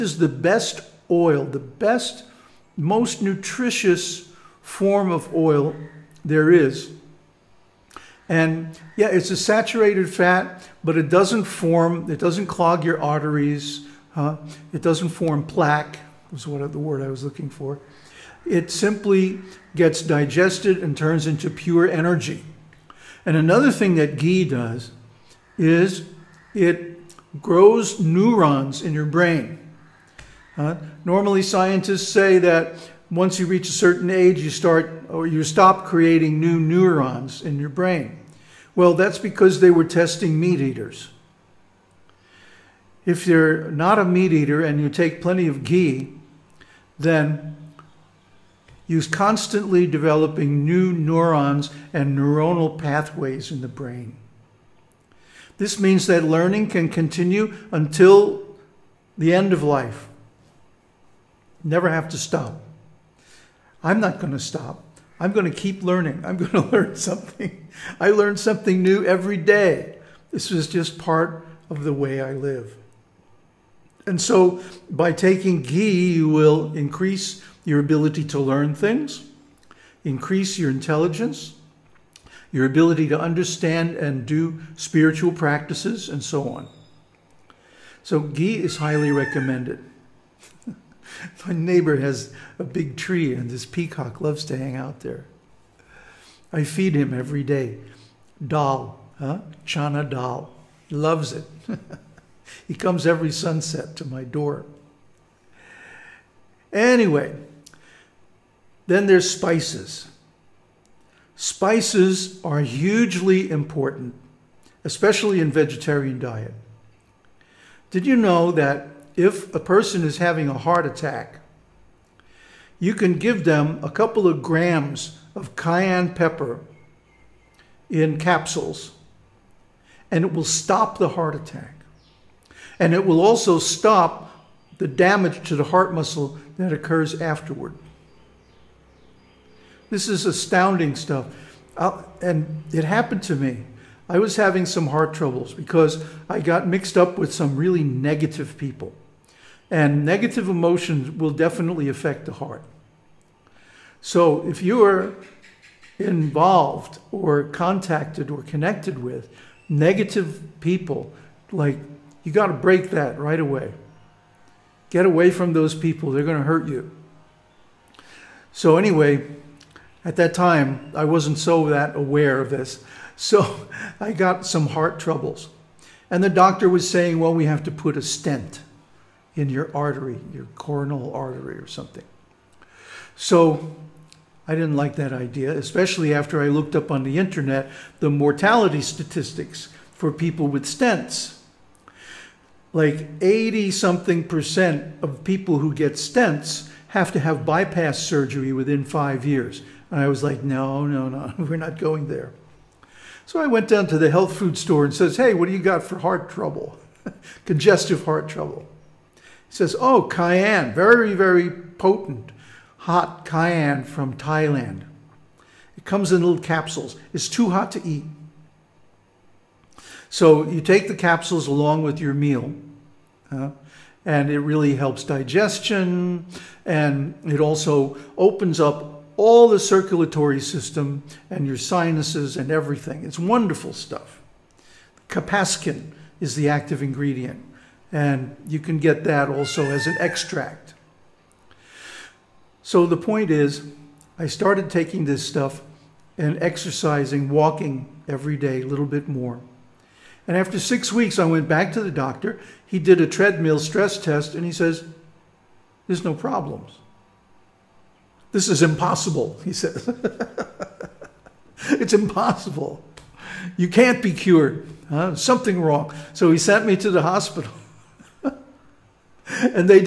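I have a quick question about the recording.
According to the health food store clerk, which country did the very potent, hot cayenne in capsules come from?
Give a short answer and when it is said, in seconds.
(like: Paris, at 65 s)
Thailand, at 214 s.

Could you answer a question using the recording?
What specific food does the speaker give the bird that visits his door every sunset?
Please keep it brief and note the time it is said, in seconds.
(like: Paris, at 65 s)
chana dal, at 99 s.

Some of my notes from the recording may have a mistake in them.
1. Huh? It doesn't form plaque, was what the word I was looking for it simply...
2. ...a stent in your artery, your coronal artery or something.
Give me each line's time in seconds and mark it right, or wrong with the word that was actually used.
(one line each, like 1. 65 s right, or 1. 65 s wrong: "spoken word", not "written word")
1. 14 s right
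2. 177 s right.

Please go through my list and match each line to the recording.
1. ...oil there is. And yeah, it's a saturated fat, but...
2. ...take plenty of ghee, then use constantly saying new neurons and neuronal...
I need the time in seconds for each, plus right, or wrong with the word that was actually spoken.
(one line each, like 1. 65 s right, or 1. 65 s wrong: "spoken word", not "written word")
1. 5 s right
2. 44 s wrong: "developing", not "saying".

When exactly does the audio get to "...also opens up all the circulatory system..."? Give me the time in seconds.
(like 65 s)
227 s.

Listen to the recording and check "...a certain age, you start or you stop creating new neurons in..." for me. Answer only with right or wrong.
right.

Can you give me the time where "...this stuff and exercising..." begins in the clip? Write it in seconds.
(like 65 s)
245 s.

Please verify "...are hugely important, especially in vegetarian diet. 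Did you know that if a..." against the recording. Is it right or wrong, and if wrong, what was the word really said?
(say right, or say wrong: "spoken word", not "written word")
right.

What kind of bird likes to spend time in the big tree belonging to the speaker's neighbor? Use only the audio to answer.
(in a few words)
peacock.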